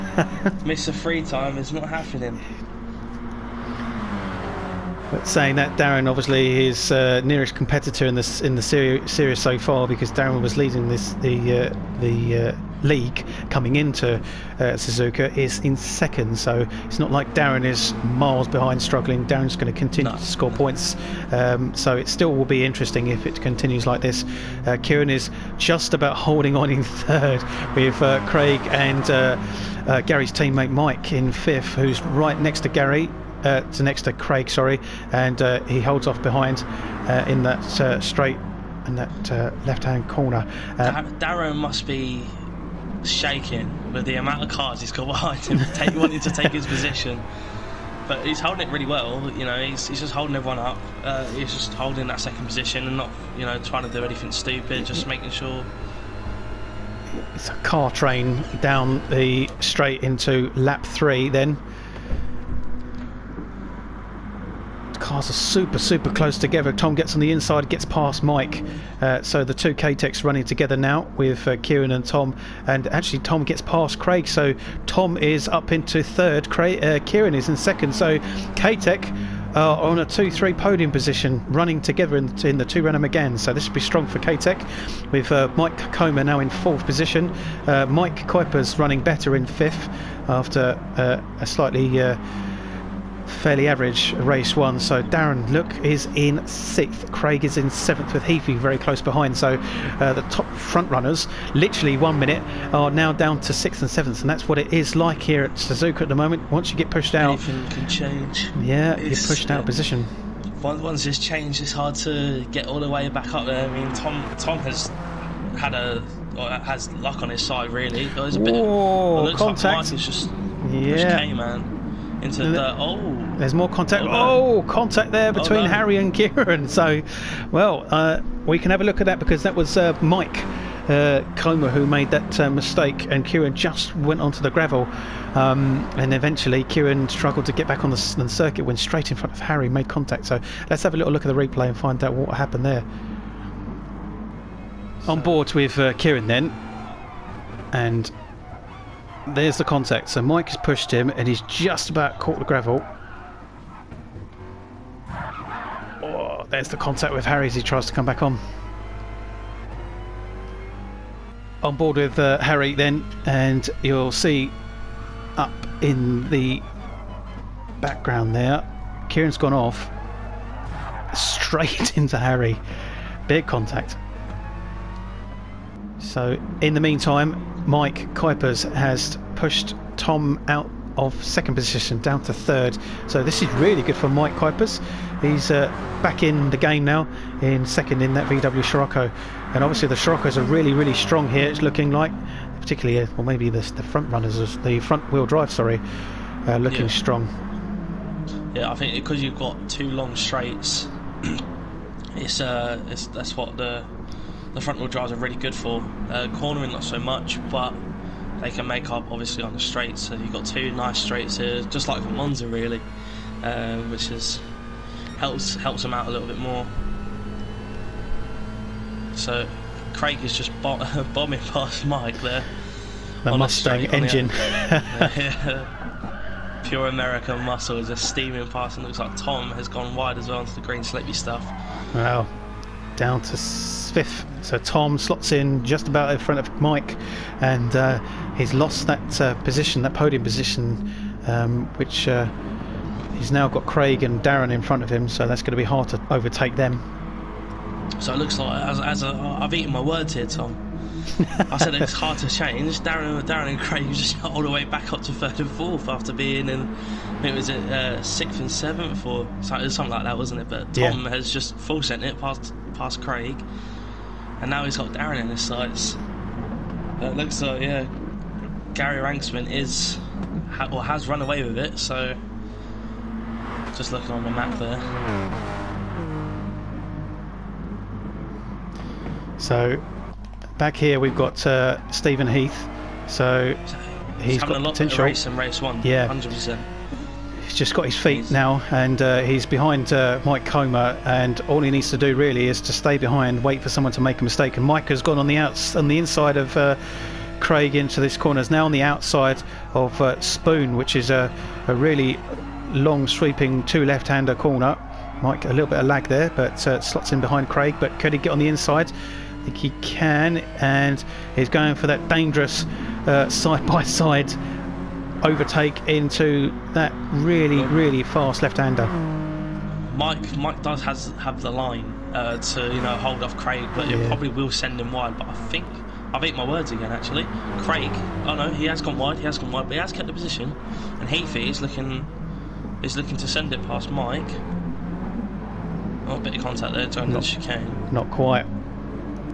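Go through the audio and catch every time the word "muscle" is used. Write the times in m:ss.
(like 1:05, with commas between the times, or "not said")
3:47.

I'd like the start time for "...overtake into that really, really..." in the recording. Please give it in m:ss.
5:15.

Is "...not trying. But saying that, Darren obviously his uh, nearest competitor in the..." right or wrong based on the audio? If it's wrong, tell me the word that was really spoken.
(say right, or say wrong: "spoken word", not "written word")
wrong: "happening", not "trying".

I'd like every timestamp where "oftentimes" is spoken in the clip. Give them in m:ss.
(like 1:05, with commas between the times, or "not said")
not said.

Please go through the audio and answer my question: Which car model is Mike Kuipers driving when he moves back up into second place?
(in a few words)
VW Scirocco.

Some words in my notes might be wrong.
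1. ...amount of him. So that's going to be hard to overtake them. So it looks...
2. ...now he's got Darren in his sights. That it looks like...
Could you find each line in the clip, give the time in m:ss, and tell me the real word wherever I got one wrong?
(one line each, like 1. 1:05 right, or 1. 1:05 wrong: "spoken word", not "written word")
1. 4:04 wrong: "front", not "amount"
2. 4:24 right.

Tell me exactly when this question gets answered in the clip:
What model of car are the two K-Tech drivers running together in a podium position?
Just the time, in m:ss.
1:22.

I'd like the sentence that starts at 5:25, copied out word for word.
But I think I've ate my words again.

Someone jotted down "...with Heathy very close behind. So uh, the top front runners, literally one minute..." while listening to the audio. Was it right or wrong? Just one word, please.
right.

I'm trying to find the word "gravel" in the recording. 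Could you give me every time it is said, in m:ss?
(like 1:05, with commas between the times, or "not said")
2:14, 2:32.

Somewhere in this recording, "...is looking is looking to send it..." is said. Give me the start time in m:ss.
5:31.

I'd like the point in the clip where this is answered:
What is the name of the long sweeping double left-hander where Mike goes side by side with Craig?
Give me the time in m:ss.
5:00.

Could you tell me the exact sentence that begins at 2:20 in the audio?
So let's have a little look at the replay and find out what happened there.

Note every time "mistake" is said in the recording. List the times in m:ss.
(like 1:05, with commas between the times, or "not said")
2:12, 4:54.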